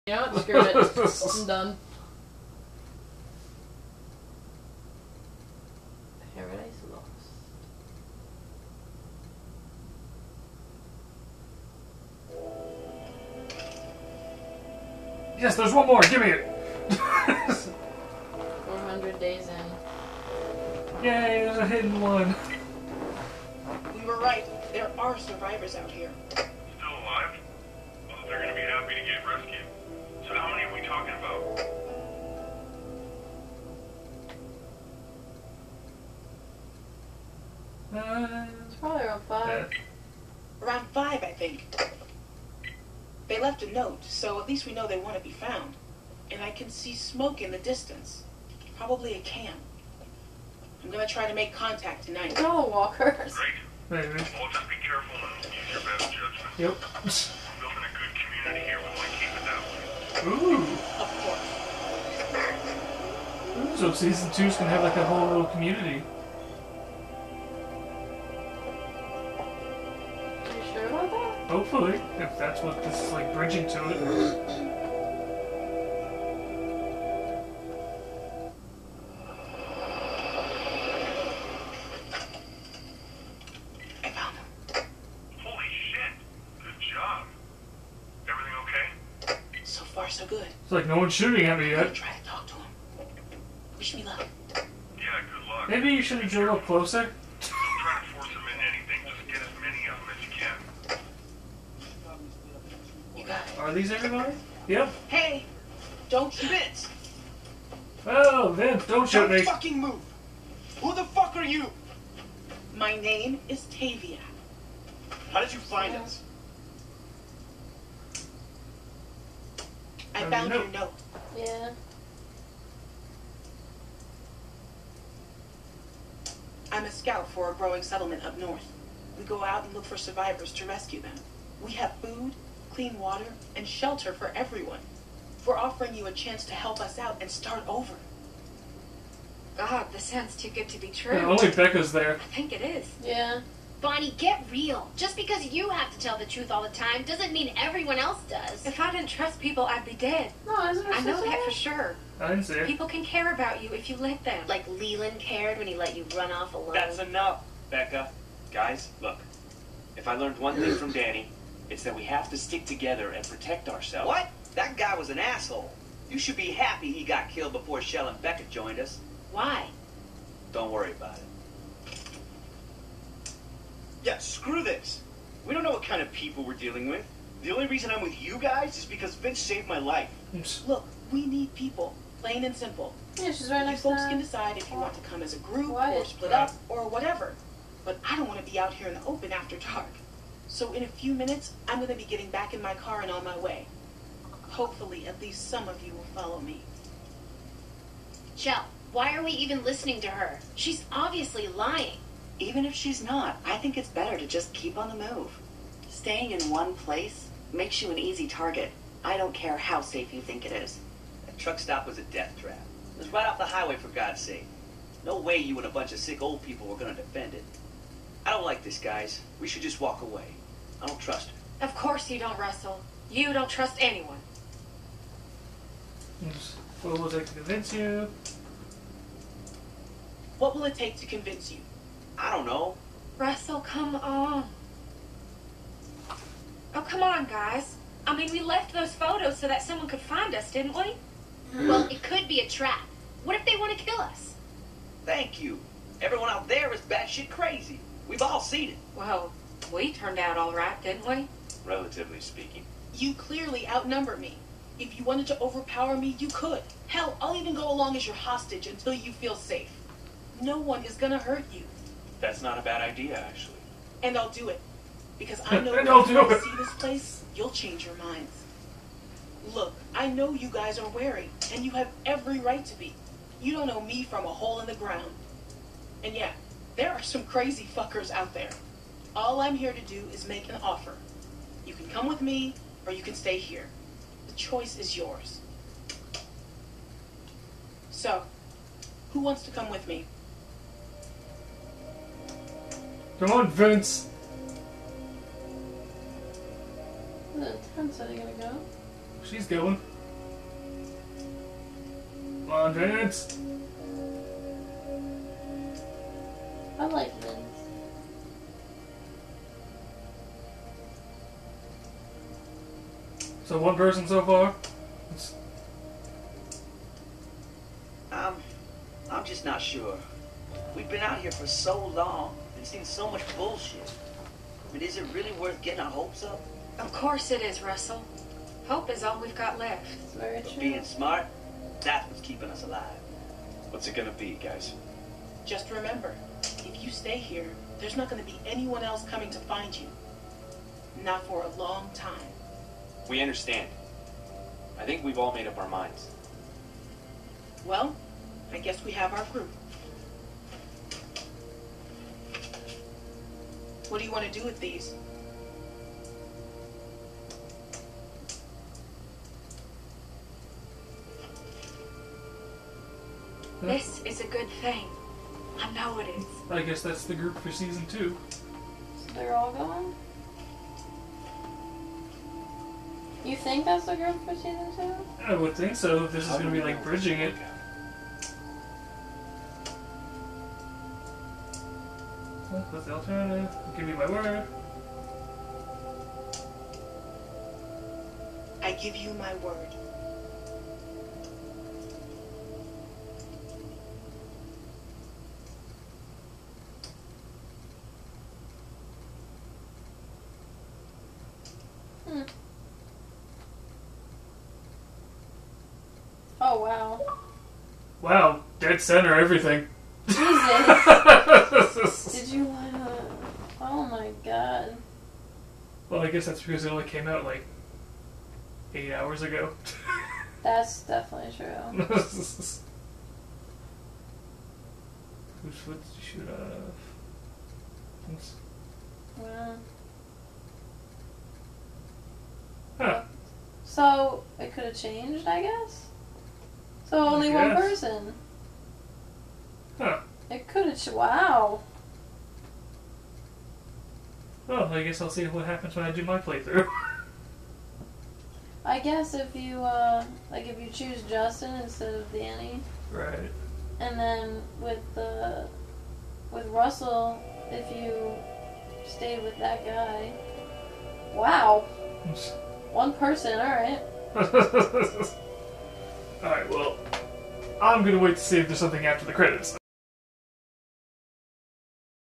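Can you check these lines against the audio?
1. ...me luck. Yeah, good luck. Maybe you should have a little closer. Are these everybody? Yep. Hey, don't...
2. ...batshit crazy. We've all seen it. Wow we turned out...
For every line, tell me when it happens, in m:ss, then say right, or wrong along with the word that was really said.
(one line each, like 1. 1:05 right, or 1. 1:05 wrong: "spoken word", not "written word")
1. 1:33 right
2. 4:06 right.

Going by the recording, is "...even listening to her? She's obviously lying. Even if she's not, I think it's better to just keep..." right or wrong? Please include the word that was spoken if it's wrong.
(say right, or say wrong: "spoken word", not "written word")
right.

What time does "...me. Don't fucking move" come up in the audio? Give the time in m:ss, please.
1:49.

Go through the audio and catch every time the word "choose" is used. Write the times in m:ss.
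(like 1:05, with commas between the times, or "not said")
7:30.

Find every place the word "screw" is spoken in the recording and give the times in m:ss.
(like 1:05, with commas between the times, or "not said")
0:00, 2:54.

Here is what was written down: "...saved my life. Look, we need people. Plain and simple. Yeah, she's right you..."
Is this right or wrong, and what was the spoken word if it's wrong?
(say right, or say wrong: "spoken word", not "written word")
right.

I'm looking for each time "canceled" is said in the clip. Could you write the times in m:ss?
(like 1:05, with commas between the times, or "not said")
not said.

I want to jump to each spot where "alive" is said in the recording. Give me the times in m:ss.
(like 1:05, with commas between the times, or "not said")
0:27, 5:32.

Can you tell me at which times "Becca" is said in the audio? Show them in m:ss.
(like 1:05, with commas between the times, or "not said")
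2:21, 2:37, 2:48.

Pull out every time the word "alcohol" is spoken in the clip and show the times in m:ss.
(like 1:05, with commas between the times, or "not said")
not said.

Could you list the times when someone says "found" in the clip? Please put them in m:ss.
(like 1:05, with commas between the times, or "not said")
0:45, 2:00.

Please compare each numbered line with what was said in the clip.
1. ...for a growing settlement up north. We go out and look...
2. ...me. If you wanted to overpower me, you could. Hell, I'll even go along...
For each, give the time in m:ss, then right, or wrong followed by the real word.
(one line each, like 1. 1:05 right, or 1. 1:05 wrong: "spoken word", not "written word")
1. 2:07 right
2. 4:14 right.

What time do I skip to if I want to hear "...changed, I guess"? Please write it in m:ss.
7:14.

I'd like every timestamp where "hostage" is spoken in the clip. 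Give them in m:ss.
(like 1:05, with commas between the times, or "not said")
4:18.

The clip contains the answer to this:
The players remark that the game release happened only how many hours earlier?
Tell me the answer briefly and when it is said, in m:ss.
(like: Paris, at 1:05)
8, at 6:58.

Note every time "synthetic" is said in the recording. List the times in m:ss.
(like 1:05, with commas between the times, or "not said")
not said.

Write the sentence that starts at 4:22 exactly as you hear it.
That's not a bad idea, actually.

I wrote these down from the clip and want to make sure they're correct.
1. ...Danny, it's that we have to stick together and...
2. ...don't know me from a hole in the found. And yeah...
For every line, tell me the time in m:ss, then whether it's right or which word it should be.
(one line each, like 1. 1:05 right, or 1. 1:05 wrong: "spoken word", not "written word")
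1. 2:40 right
2. 4:33 wrong: "ground", not "found".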